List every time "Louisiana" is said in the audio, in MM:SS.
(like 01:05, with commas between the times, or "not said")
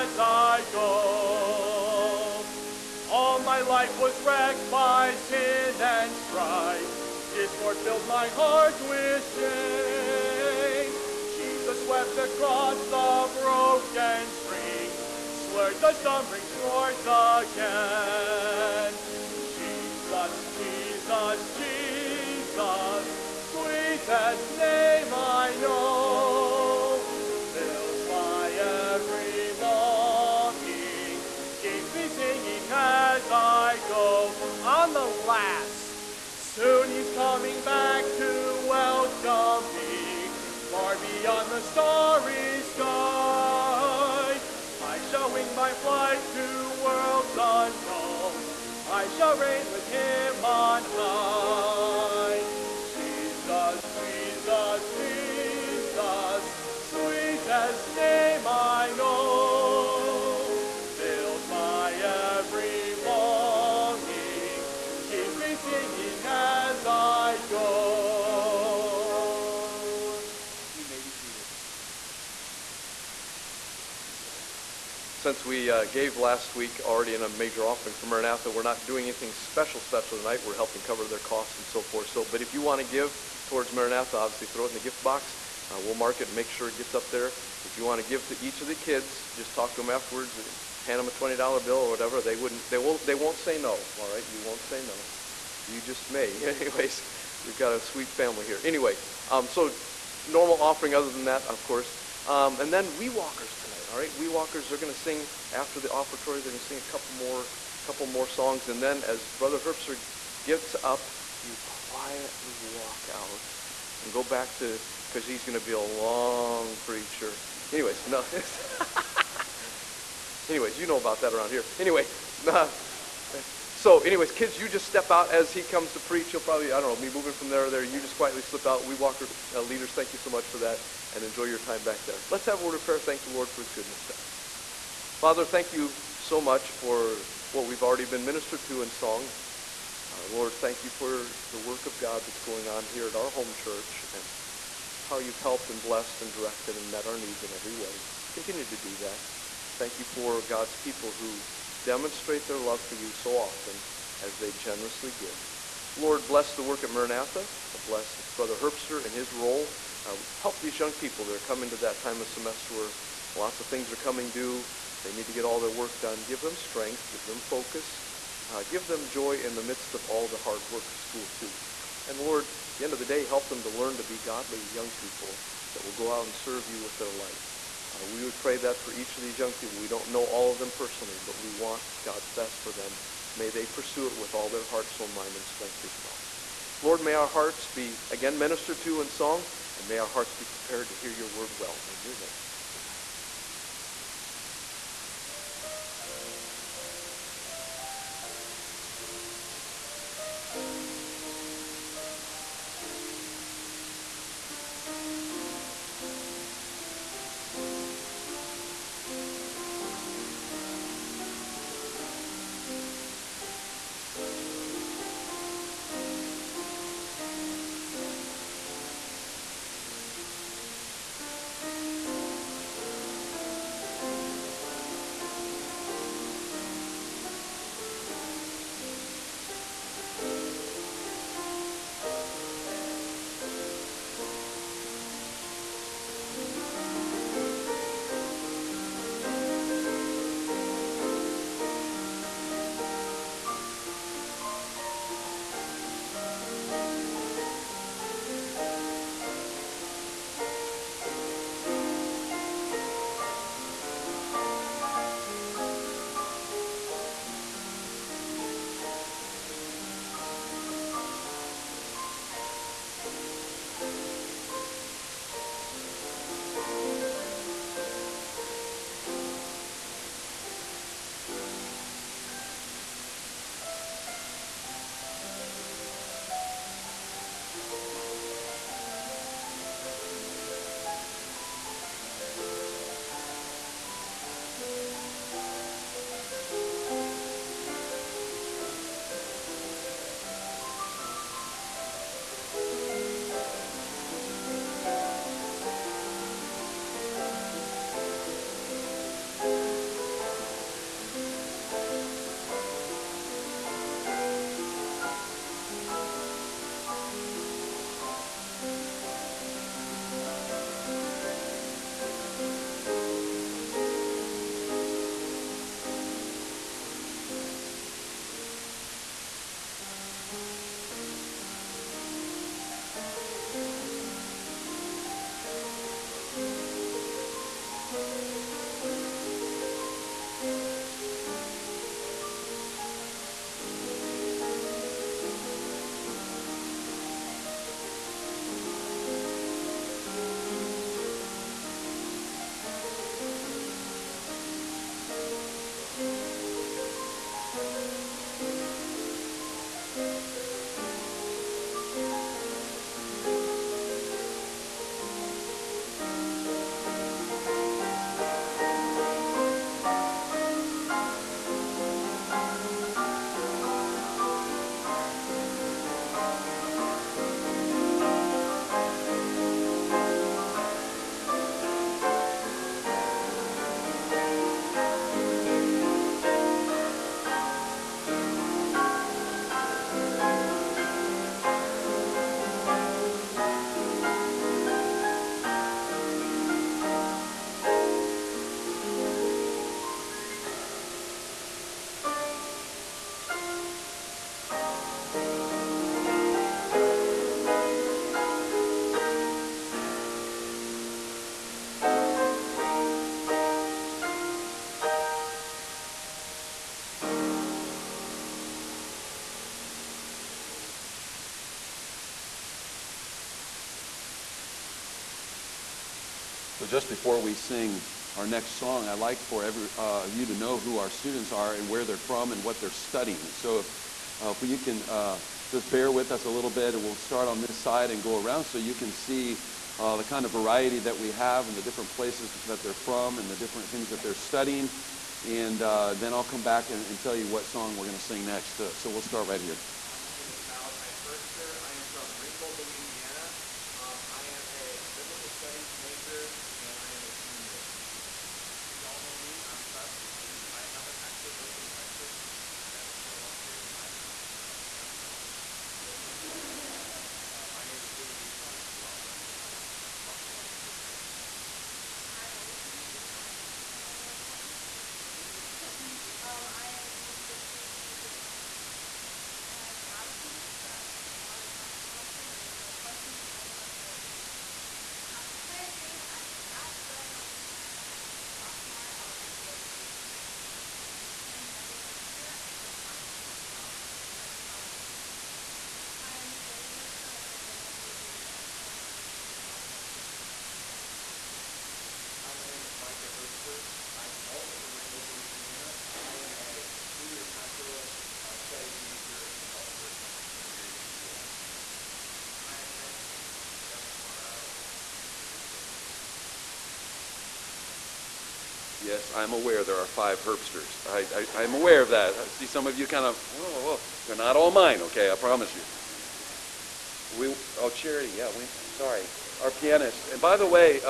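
07:22, 08:07, 08:15.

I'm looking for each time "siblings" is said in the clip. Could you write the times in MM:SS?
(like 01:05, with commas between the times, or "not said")
07:45.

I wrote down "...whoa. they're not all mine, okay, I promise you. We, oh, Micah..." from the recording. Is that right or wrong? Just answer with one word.
wrong.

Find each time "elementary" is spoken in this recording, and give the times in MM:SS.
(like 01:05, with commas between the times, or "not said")
07:53, 07:59.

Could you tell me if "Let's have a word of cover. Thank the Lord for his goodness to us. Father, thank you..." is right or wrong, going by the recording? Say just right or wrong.
wrong.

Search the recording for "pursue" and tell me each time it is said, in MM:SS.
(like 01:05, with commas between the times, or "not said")
03:03.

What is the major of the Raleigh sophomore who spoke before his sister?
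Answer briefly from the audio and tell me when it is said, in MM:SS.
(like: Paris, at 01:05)
exercise science, at 07:40.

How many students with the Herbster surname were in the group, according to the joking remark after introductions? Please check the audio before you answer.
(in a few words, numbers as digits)
5.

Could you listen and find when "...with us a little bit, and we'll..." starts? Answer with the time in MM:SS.
07:05.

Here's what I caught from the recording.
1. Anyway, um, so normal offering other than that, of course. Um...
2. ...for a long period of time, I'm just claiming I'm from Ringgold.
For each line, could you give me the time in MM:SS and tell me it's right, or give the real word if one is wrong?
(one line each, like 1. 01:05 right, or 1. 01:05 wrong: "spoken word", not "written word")
1. 01:38 right
2. 07:33 wrong: "Watertown", not "Ringgold".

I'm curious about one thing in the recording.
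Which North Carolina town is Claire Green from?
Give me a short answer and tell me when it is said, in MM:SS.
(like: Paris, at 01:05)
Asheboro, at 07:56.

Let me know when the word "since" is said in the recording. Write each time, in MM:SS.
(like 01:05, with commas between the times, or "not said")
01:15, 07:30.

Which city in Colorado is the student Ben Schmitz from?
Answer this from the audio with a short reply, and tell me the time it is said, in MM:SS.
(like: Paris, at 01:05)
Denver, at 08:23.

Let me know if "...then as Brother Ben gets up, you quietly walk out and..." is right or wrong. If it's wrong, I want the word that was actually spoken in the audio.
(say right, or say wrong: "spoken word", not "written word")
wrong: "Herbster", not "Ben".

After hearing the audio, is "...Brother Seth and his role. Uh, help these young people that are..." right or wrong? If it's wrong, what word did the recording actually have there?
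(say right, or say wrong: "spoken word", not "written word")
wrong: "Herbster", not "Seth".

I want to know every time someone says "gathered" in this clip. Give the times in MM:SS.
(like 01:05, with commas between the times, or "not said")
not said.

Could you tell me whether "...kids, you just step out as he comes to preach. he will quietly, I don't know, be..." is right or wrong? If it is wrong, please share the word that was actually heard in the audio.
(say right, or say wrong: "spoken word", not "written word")
wrong: "probably", not "quietly".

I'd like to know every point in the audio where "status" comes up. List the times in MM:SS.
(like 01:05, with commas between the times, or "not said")
not said.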